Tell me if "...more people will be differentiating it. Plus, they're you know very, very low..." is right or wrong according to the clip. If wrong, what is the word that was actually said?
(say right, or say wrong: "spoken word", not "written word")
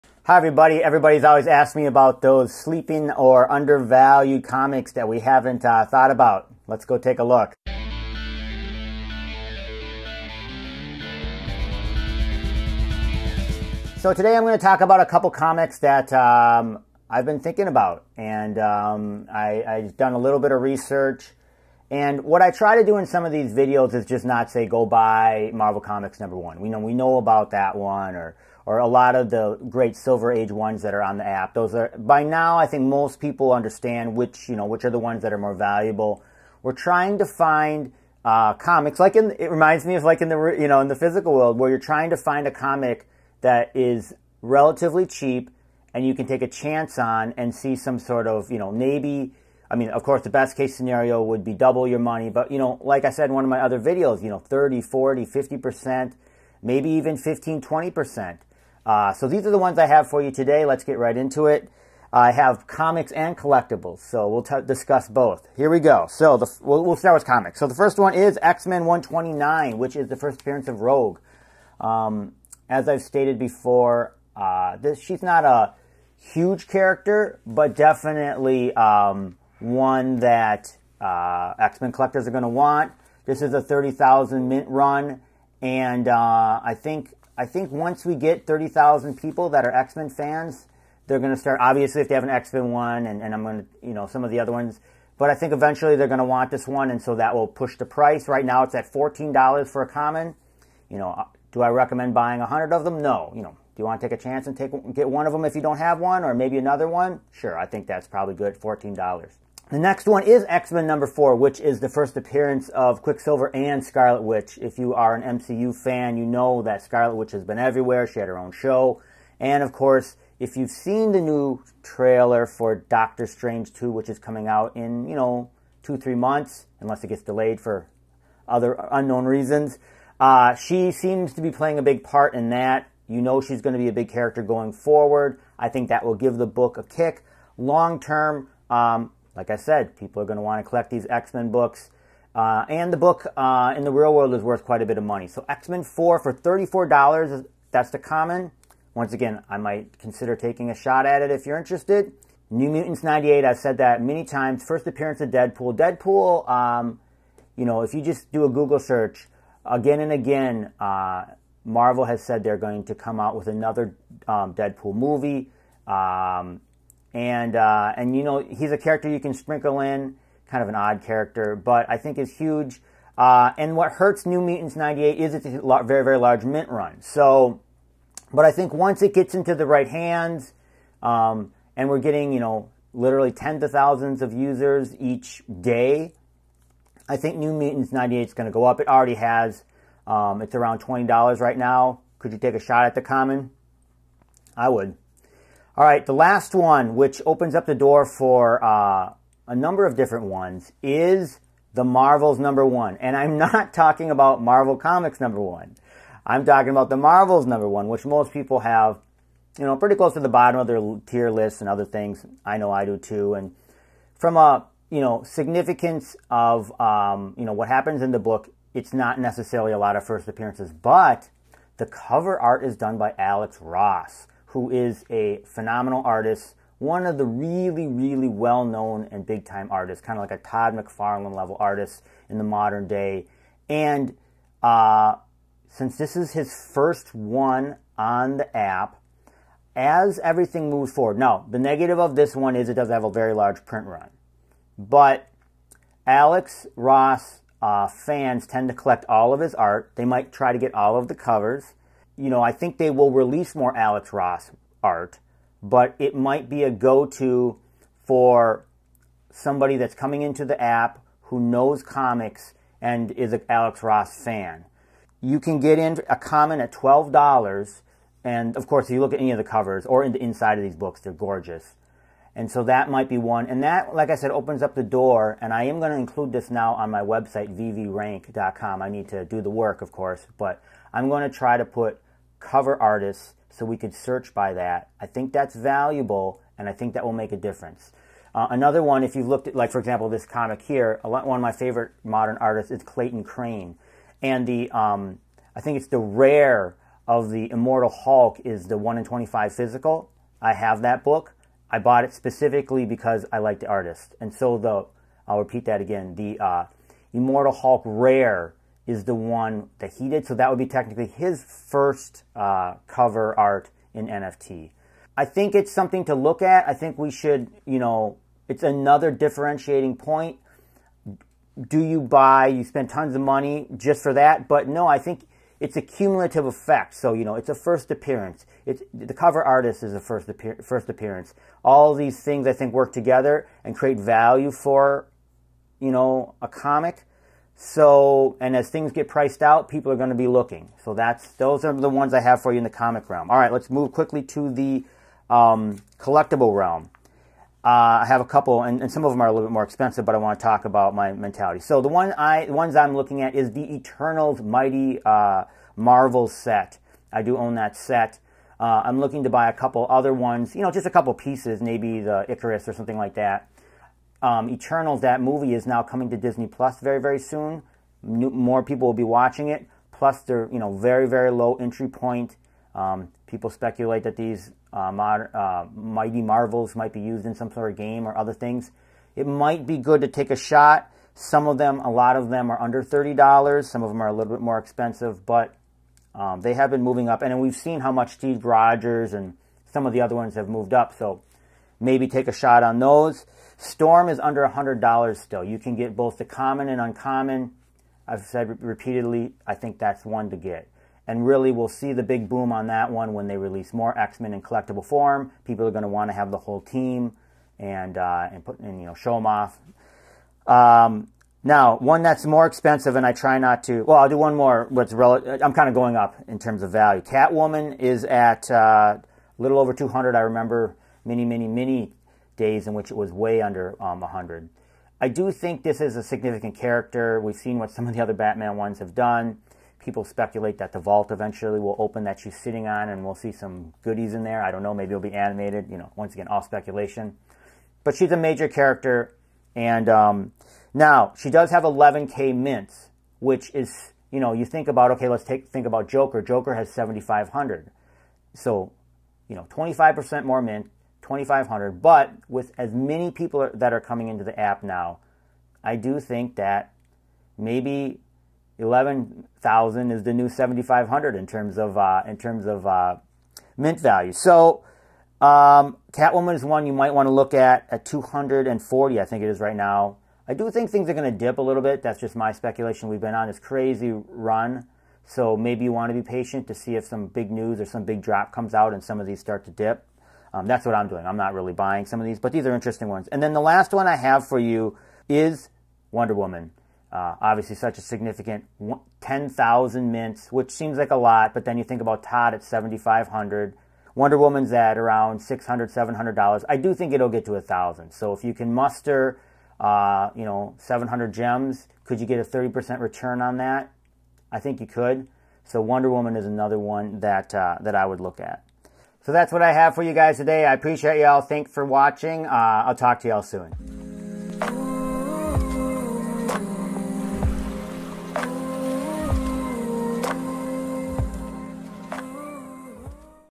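wrong: "watching", not "differentiating".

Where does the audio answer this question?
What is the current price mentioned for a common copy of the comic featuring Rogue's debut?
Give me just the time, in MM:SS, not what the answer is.
01:38.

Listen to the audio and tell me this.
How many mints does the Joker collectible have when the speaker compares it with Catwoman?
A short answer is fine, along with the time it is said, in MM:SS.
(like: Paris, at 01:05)
7,500, at 07:26.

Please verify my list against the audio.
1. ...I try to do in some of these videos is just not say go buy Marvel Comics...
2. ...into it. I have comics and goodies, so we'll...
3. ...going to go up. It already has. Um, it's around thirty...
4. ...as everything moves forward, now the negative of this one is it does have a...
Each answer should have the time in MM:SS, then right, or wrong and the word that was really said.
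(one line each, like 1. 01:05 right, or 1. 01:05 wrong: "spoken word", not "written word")
1. 00:22 right
2. 01:01 wrong: "collectibles", not "goodies"
3. 03:08 wrong: "twenty", not "thirty"
4. 03:59 right.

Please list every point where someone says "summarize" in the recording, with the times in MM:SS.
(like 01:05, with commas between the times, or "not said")
not said.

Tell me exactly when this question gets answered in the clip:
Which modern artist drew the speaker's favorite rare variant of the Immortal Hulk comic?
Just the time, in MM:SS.
04:52.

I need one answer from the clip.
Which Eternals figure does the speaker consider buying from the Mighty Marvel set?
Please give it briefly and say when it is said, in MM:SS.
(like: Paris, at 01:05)
Icarus, at 06:02.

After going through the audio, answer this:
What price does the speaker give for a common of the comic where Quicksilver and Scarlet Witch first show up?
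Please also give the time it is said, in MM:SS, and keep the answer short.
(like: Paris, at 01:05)
$34, at 02:26.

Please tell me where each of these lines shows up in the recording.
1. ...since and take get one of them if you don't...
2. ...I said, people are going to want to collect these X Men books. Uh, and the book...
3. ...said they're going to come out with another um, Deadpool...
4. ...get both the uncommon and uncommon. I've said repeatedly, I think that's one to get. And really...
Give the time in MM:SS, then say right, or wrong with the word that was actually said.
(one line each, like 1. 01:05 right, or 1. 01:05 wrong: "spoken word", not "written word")
1. 01:44 wrong: "chance", not "since"
2. 02:19 right
3. 02:42 right
4. 06:35 wrong: "common", not "uncommon".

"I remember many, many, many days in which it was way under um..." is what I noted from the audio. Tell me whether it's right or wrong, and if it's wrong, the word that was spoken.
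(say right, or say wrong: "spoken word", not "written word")
right.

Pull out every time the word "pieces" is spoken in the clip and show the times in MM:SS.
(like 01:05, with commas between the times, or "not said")
06:01.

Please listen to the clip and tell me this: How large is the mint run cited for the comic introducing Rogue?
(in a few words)
30,000.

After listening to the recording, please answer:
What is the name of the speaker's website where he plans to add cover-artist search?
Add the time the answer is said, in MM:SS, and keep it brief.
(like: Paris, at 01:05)
veverank.com, at 04:37.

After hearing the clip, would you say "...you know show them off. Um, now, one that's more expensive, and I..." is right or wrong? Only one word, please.
right.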